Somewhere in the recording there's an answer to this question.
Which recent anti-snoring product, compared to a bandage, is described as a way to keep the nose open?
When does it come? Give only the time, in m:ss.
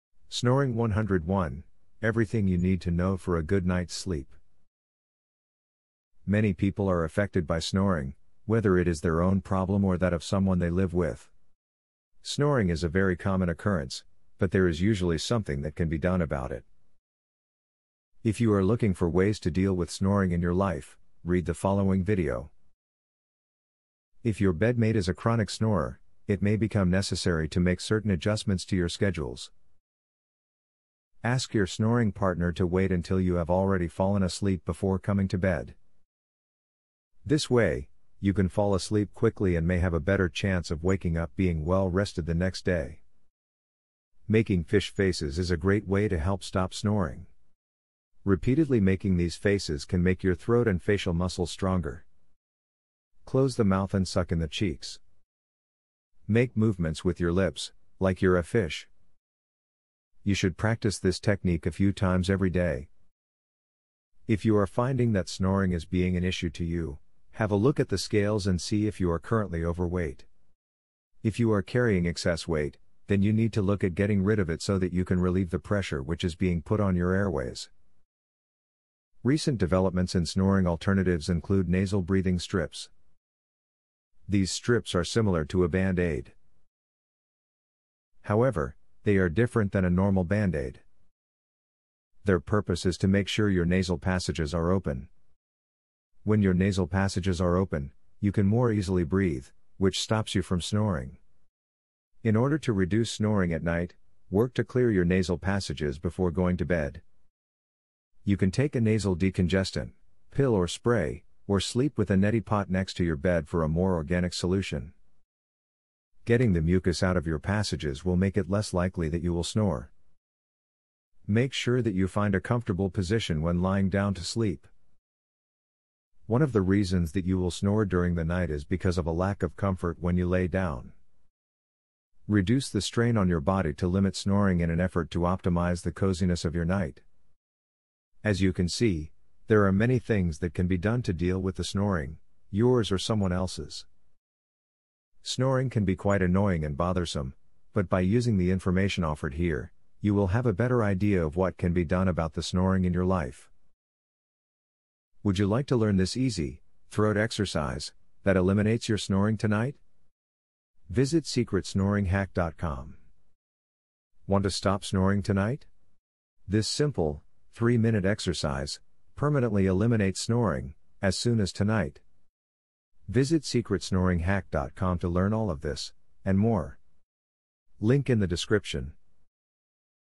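1:21.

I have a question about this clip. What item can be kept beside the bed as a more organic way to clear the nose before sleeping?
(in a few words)
neti pot.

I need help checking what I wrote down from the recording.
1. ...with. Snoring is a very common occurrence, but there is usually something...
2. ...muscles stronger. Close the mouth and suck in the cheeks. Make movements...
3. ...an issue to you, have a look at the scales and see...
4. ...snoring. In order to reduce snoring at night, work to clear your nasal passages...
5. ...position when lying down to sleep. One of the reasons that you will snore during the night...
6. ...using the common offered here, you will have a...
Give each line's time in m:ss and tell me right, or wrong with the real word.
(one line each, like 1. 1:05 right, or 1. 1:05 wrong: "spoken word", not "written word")
1. 0:10 right
2. 0:51 right
3. 1:06 right
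4. 1:40 right
5. 2:02 right
6. 2:27 wrong: "information", not "common".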